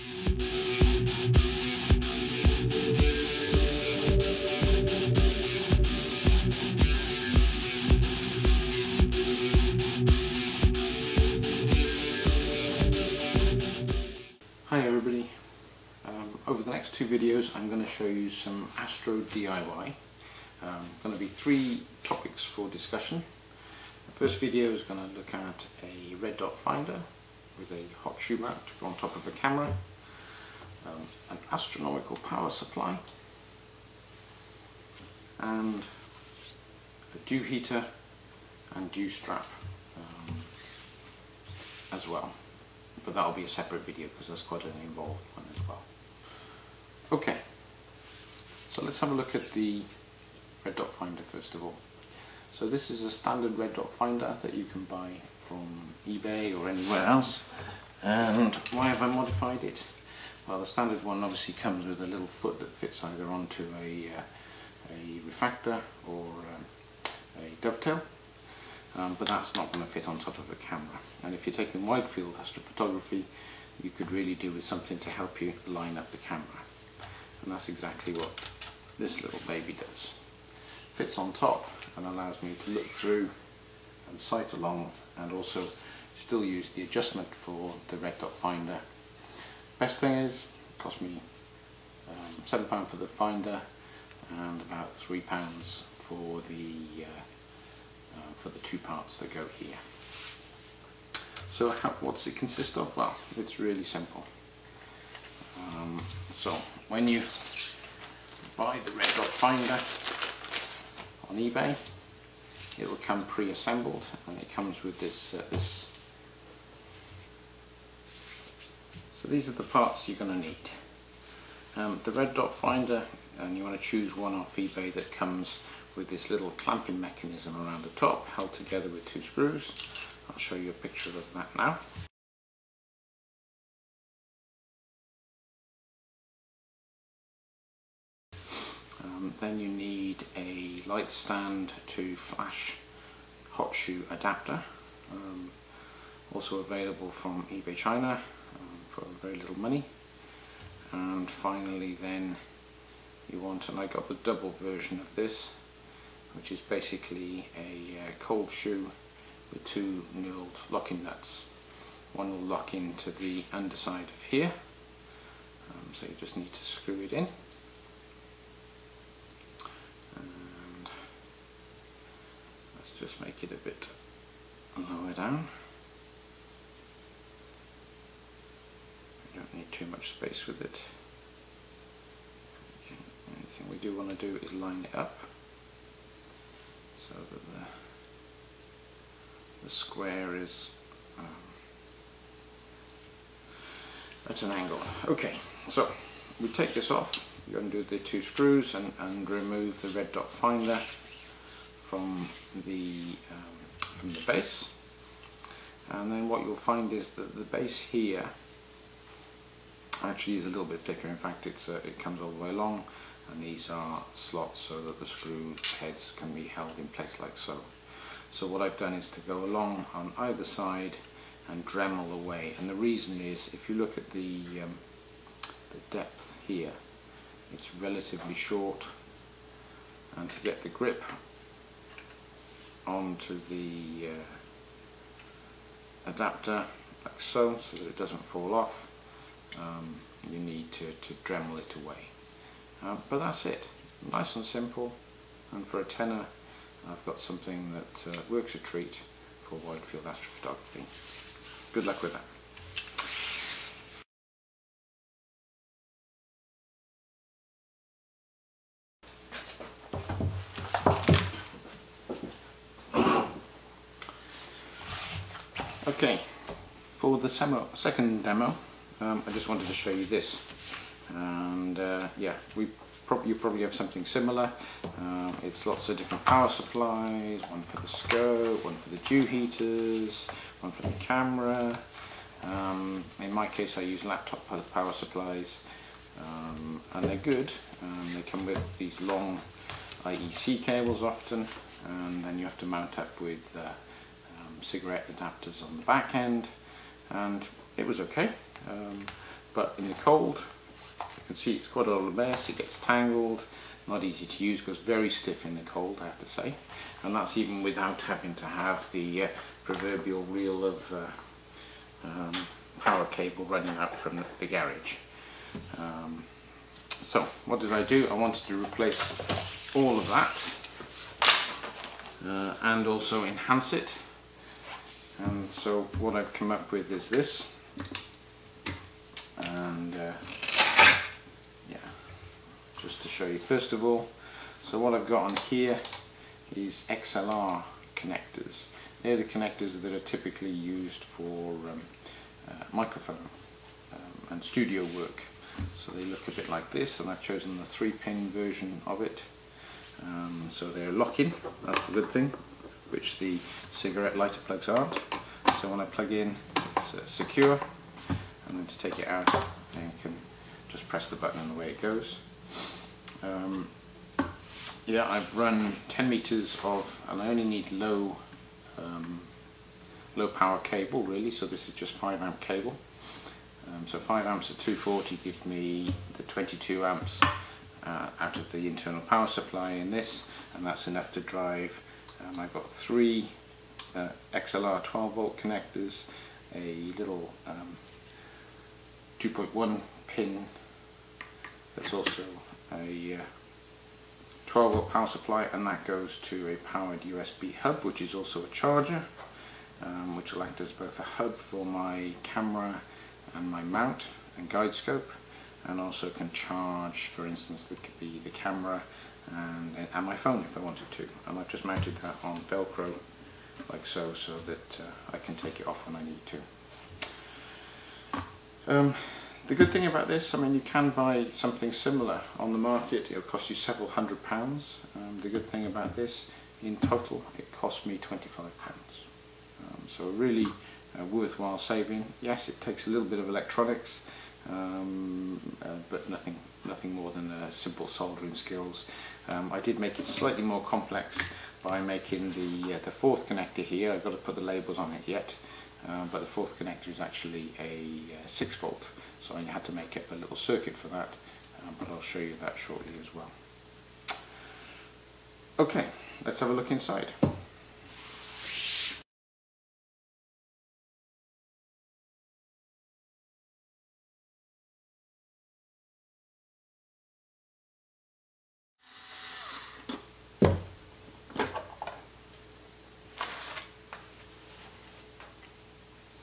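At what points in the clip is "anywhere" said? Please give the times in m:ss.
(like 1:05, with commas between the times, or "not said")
0:56.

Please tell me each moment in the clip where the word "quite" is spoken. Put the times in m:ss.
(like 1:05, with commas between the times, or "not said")
0:44, 5:01.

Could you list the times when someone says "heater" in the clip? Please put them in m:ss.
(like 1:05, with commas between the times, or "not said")
0:37, 4:39.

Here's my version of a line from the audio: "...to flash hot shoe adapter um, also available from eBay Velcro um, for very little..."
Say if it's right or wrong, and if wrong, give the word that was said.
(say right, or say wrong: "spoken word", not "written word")
wrong: "China", not "Velcro".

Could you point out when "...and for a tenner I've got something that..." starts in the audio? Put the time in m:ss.
4:05.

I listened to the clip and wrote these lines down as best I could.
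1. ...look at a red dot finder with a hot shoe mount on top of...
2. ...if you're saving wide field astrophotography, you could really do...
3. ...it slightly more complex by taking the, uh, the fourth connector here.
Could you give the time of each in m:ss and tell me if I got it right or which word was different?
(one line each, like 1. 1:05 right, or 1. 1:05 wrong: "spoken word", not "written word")
1. 0:25 right
2. 1:11 wrong: "taking", not "saving"
3. 7:19 wrong: "making", not "taking".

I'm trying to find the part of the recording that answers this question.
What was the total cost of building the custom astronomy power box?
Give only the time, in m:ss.
7:07.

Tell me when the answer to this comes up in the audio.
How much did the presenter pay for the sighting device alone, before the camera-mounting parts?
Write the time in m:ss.
1:32.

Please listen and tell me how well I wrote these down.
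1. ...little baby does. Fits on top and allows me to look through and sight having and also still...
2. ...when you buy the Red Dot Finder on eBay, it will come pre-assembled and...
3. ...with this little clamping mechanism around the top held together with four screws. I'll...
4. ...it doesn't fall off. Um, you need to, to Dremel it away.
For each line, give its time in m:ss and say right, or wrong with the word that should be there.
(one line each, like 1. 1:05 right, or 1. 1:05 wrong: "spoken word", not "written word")
1. 1:19 wrong: "along", not "having"
2. 1:46 right
3. 2:05 wrong: "two", not "four"
4. 3:57 right.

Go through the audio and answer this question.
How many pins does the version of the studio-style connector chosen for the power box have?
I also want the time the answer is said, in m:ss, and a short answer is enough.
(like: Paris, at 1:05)
3, at 5:47.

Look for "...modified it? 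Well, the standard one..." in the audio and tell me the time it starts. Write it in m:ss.
0:59.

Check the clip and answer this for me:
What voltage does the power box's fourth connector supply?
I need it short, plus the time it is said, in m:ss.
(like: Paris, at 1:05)
6 volts, at 7:28.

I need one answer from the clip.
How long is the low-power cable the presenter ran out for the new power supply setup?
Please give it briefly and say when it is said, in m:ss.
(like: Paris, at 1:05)
10 meters, at 6:05.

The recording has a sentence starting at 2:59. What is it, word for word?
We don't need too much space with it.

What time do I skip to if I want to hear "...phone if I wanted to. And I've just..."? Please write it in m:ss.
6:50.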